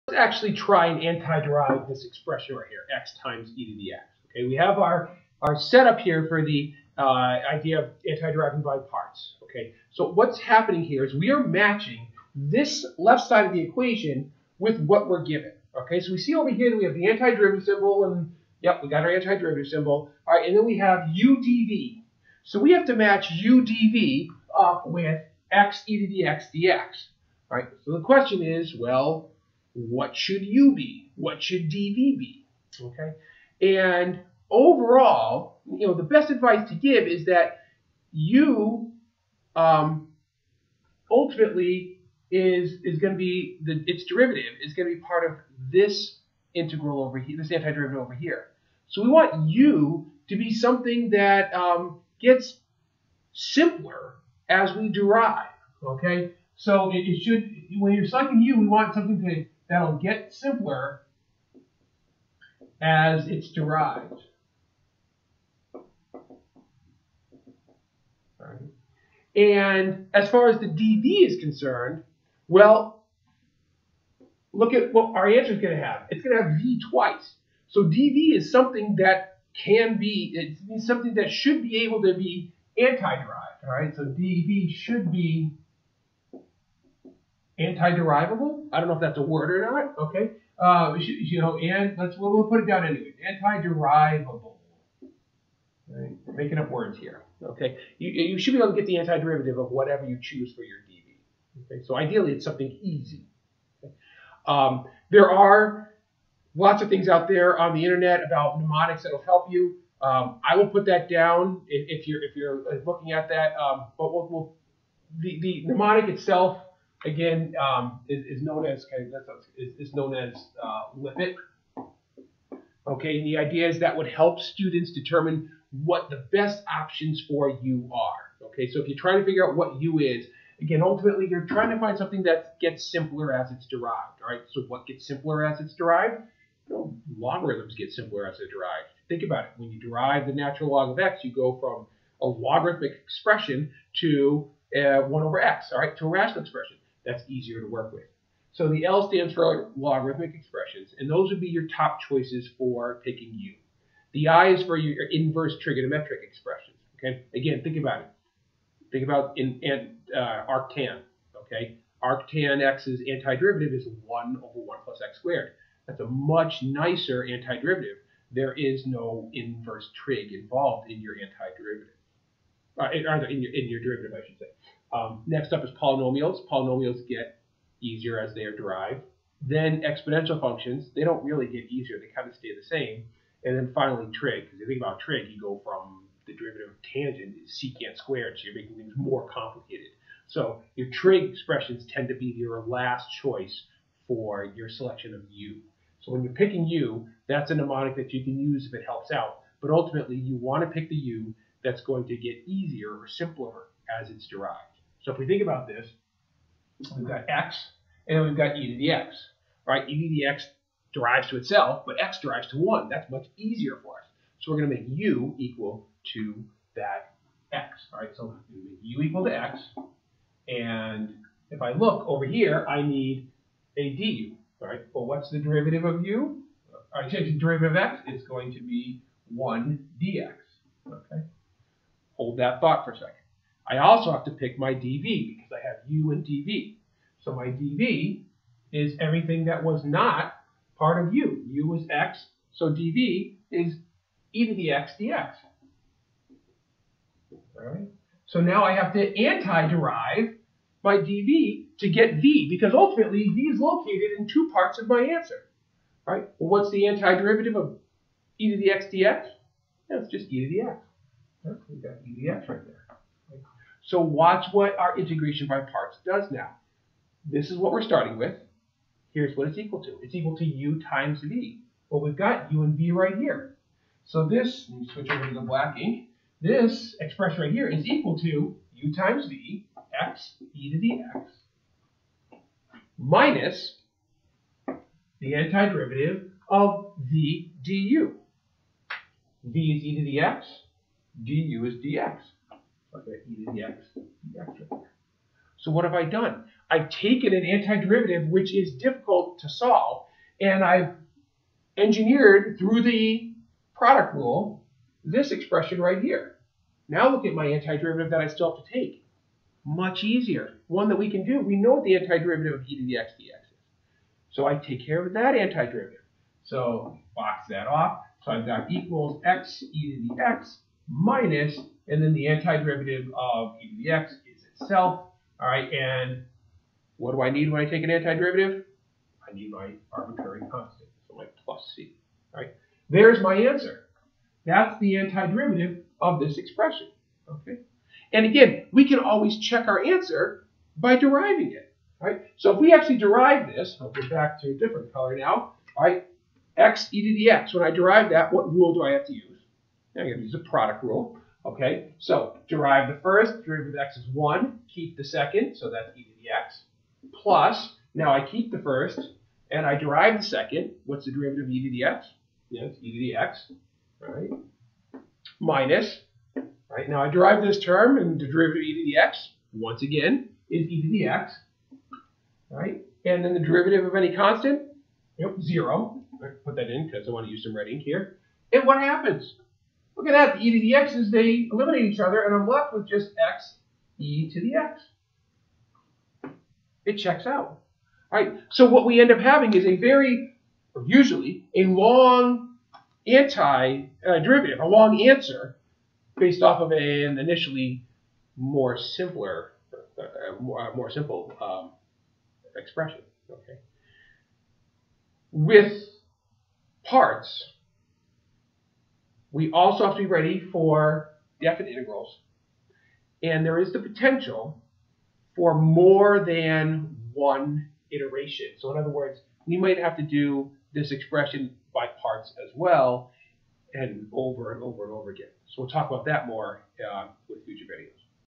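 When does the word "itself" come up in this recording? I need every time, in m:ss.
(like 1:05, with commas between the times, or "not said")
1:56, 3:31, 5:24.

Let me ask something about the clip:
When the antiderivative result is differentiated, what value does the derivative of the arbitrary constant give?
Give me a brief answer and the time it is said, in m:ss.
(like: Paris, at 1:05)
0, at 6:15.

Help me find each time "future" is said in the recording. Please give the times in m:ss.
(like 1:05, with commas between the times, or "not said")
7:07.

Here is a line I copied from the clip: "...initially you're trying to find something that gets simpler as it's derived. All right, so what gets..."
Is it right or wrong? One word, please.
wrong.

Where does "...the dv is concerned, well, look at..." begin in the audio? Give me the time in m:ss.
1:10.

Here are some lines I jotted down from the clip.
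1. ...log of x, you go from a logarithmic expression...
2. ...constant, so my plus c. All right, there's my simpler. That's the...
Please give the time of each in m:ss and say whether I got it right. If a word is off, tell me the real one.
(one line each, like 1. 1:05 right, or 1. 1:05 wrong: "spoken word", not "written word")
1. 2:20 right
2. 5:30 wrong: "answer", not "simpler".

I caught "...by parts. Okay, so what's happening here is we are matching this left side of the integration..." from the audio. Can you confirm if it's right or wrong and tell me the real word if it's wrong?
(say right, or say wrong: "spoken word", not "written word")
wrong: "equation", not "integration".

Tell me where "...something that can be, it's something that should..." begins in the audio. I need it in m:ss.
1:18.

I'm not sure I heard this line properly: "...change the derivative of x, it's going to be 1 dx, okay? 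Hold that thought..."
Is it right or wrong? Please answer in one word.
right.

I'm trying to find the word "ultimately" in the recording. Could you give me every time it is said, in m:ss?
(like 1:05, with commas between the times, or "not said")
0:41, 2:10, 3:19, 4:12.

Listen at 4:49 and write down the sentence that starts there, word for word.
v is e to the x, du is dx to the x, right there.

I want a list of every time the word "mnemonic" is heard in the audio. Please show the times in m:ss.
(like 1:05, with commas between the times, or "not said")
1:48, 1:55, 3:17.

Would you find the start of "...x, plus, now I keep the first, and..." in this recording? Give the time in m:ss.
5:56.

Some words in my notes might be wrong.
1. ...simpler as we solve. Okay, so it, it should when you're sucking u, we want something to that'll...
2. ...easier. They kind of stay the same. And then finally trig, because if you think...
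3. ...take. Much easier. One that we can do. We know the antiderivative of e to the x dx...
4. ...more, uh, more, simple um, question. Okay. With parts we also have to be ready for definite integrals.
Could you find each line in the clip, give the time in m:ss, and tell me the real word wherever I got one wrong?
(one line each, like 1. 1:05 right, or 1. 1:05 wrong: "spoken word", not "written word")
1. 0:53 wrong: "derive", not "solve"
2. 3:01 right
3. 5:08 right
4. 6:40 wrong: "expression", not "question".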